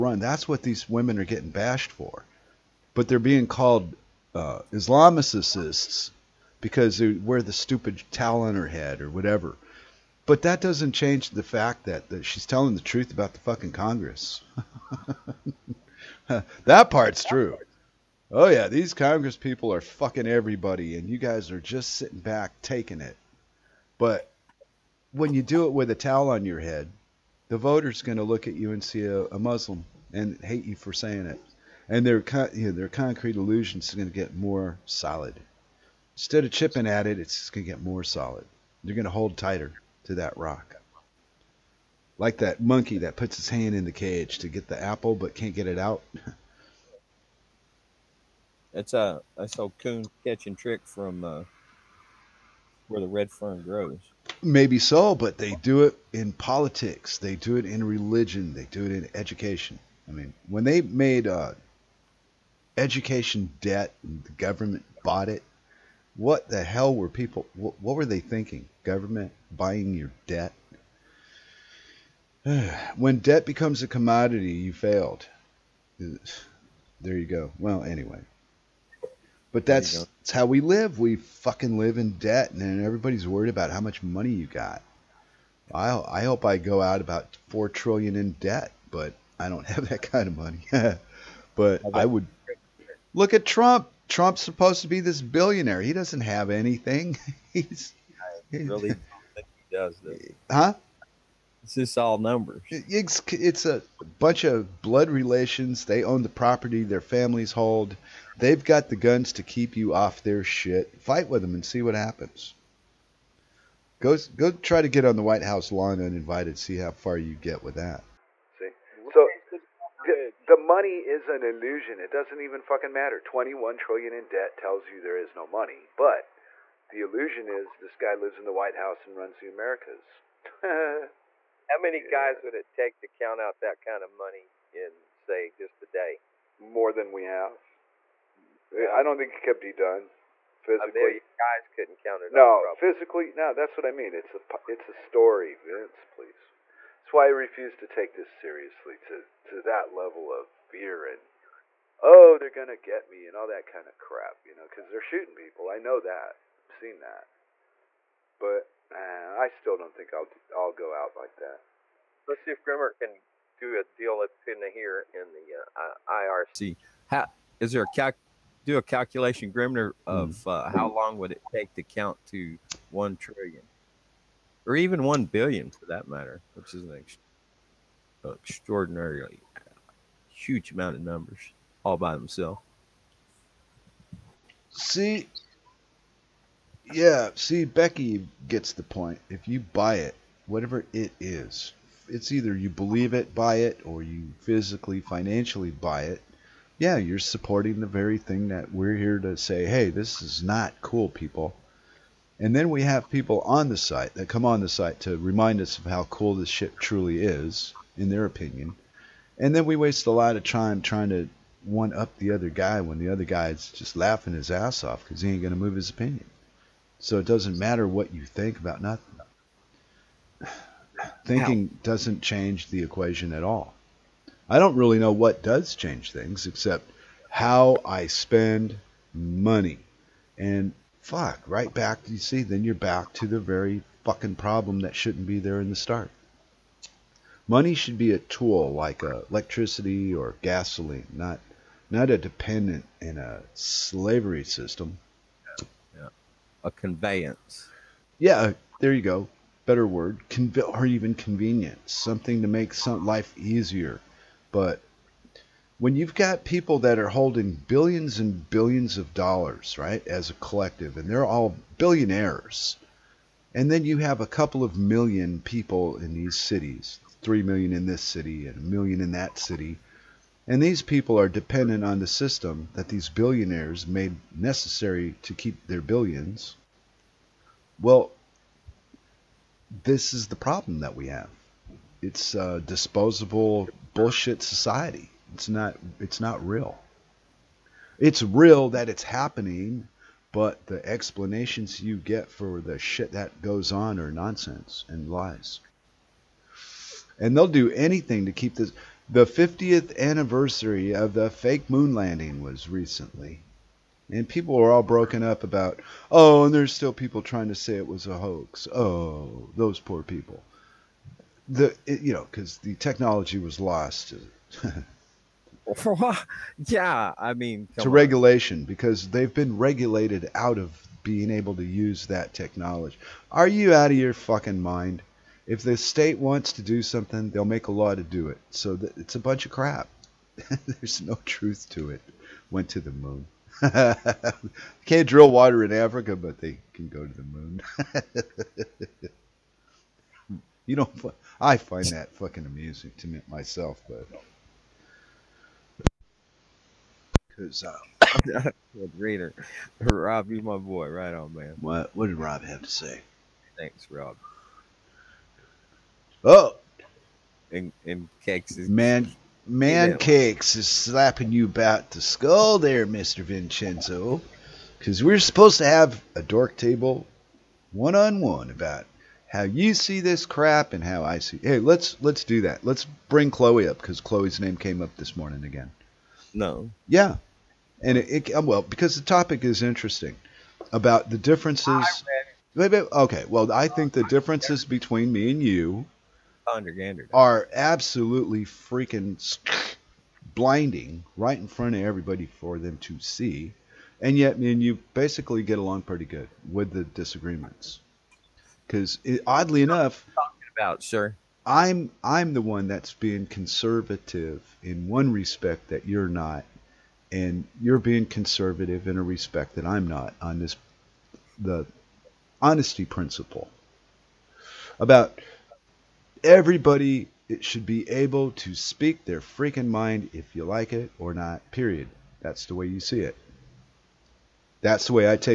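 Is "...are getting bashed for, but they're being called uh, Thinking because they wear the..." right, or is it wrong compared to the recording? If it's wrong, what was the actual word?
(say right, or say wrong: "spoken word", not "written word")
wrong: "Islamicists", not "Thinking".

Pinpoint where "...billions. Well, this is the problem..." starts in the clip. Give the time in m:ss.
4:35.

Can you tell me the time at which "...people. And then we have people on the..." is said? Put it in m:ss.
3:21.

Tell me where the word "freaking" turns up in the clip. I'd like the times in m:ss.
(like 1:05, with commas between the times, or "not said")
6:28, 6:59.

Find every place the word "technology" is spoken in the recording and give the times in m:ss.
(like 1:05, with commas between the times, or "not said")
5:12, 5:22.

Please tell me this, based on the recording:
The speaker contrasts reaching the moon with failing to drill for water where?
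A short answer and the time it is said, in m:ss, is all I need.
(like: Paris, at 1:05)
Africa, at 5:35.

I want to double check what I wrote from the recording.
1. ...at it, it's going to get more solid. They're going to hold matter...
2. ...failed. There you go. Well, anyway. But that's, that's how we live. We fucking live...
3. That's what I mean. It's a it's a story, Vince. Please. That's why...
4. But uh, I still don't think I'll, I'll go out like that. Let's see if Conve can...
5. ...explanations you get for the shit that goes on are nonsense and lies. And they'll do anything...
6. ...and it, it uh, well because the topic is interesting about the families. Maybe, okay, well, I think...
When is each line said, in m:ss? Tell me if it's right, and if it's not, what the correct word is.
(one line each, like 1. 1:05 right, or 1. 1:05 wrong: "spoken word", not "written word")
1. 0:36 wrong: "tighter", not "matter"
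2. 1:14 right
3. 2:23 right
4. 2:38 wrong: "Grimnir", not "Conve"
5. 4:50 right
6. 6:17 wrong: "differences", not "families".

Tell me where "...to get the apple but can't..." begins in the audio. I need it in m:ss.
0:44.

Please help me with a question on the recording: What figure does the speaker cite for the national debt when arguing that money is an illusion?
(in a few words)
21 trillion.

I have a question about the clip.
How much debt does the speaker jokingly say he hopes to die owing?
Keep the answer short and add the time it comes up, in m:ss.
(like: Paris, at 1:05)
4 trillion, at 1:27.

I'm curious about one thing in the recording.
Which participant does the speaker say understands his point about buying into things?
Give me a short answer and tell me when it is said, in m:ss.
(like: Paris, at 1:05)
Becky, at 3:07.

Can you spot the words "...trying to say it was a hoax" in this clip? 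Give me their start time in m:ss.
5:07.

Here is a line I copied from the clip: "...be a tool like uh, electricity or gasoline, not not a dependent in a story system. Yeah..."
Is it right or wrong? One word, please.
wrong.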